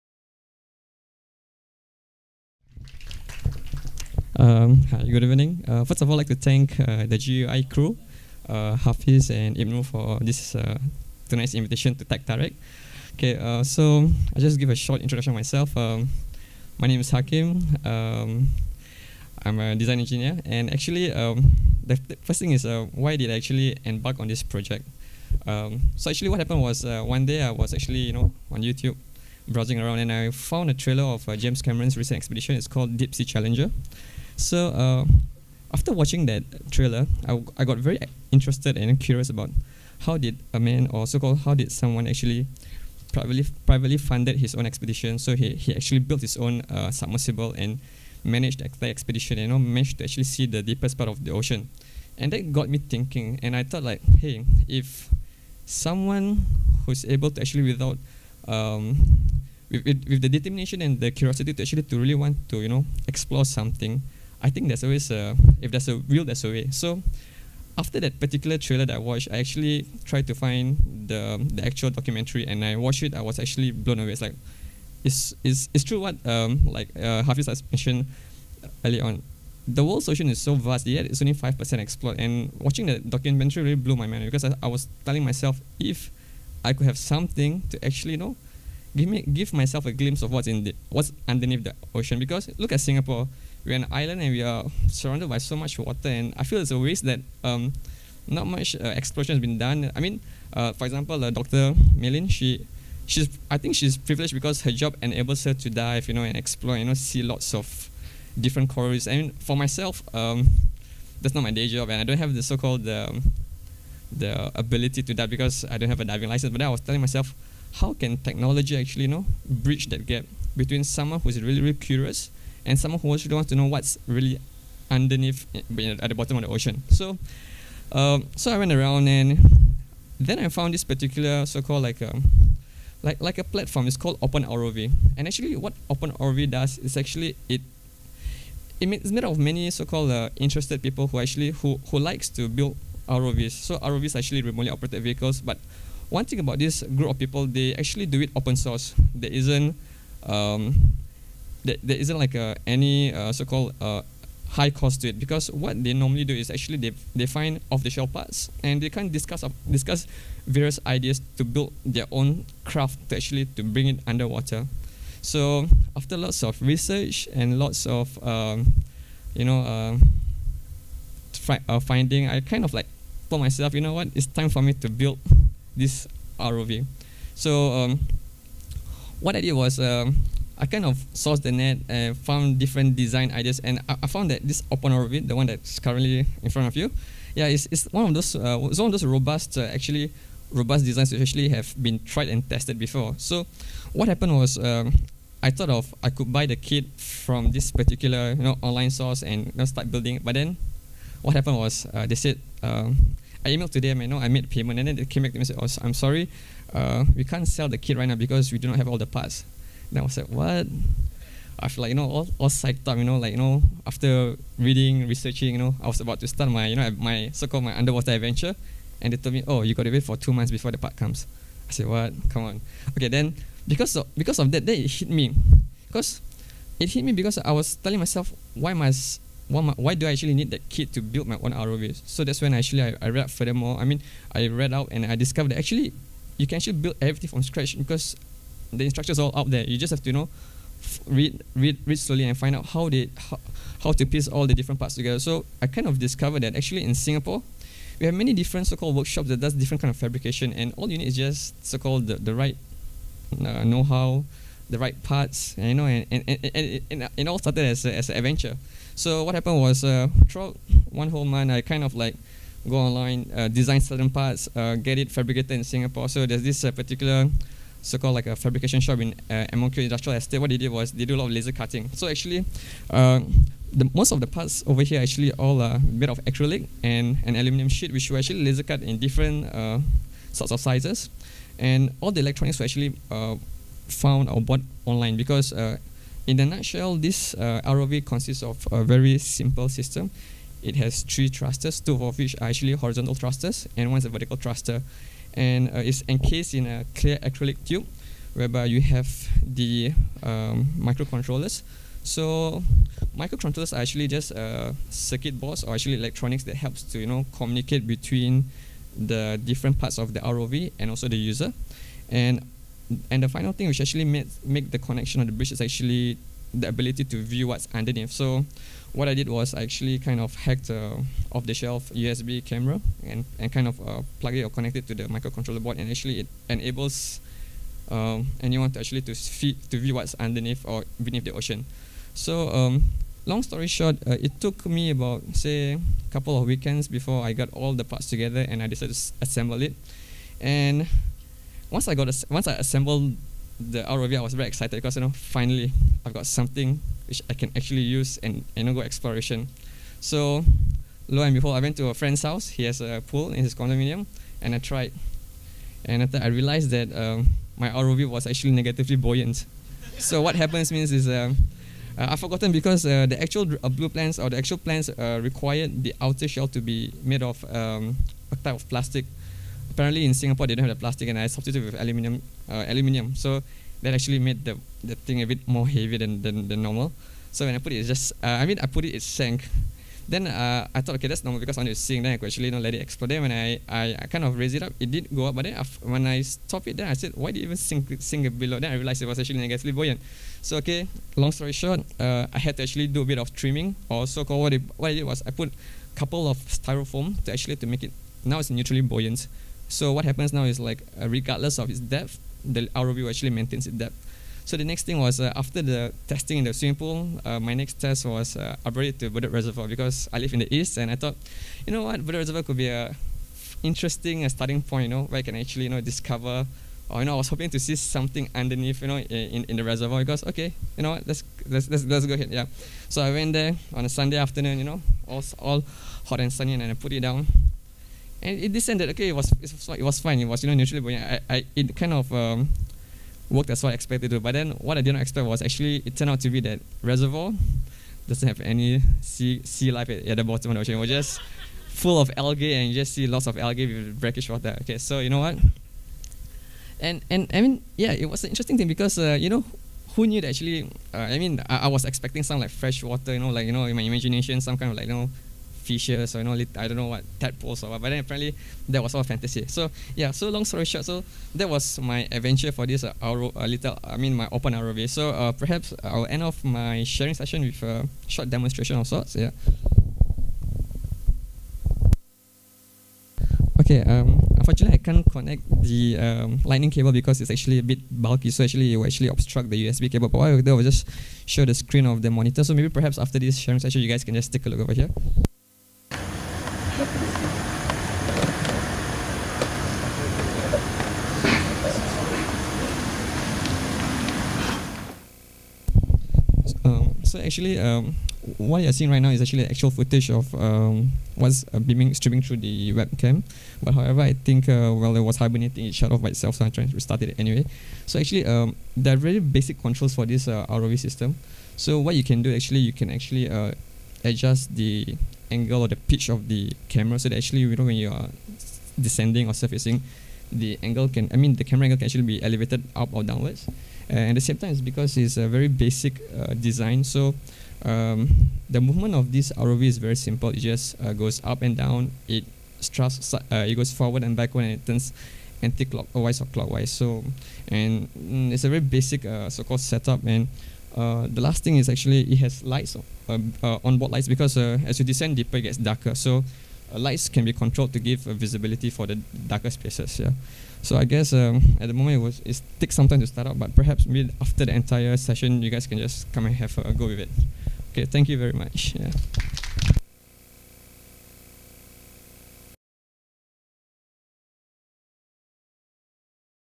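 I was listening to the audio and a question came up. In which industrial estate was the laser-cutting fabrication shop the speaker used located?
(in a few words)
MOQ Industrial Estate.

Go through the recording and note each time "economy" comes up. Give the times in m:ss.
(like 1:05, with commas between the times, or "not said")
not said.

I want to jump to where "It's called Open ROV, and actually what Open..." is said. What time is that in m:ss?
2:13.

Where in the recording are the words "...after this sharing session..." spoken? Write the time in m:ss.
8:02.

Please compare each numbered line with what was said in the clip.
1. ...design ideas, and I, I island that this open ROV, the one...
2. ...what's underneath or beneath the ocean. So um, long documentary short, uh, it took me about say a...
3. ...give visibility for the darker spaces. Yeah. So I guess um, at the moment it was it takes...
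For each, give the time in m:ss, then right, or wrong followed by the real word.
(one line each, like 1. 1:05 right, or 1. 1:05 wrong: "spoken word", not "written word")
1. 3:02 wrong: "found", not "island"
2. 5:29 wrong: "story", not "documentary"
3. 9:07 right.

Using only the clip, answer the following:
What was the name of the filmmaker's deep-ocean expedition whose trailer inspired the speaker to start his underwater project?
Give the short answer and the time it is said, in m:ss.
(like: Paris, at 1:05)
Deep Sea Challenger, at 0:32.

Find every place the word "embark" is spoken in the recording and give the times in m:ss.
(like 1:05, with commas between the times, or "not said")
0:23.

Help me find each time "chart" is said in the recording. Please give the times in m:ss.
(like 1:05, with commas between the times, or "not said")
not said.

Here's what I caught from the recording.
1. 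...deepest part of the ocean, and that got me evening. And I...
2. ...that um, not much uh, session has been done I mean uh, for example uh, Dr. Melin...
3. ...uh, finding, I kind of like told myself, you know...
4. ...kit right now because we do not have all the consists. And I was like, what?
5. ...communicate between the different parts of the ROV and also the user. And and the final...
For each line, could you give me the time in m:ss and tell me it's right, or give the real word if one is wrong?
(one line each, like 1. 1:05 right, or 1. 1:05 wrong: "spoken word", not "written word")
1. 0:50 wrong: "thinking", not "evening"
2. 1:37 wrong: "exploration", not "session"
3. 2:51 right
4. 3:27 wrong: "parts", not "consists"
5. 5:07 right.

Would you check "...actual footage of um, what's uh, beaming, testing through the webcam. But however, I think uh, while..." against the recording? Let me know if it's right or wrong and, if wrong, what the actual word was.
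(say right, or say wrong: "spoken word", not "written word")
wrong: "streaming", not "testing".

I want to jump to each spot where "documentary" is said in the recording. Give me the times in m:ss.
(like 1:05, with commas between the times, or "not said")
1:11, 1:22.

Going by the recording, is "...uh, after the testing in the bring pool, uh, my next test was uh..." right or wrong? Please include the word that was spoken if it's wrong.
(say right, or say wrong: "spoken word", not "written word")
wrong: "swimming", not "bring".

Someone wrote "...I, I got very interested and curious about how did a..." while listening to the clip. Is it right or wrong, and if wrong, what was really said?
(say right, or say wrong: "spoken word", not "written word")
right.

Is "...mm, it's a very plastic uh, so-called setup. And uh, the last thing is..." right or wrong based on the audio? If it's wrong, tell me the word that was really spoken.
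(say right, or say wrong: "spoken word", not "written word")
wrong: "basic", not "plastic".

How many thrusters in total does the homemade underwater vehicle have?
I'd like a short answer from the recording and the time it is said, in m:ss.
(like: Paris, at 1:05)
3, at 4:51.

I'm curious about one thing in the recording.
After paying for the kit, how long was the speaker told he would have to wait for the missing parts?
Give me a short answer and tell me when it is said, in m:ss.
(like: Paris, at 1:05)
Two months, at 3:40.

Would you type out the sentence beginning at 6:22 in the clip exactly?
Then I could actually you know, let it explode.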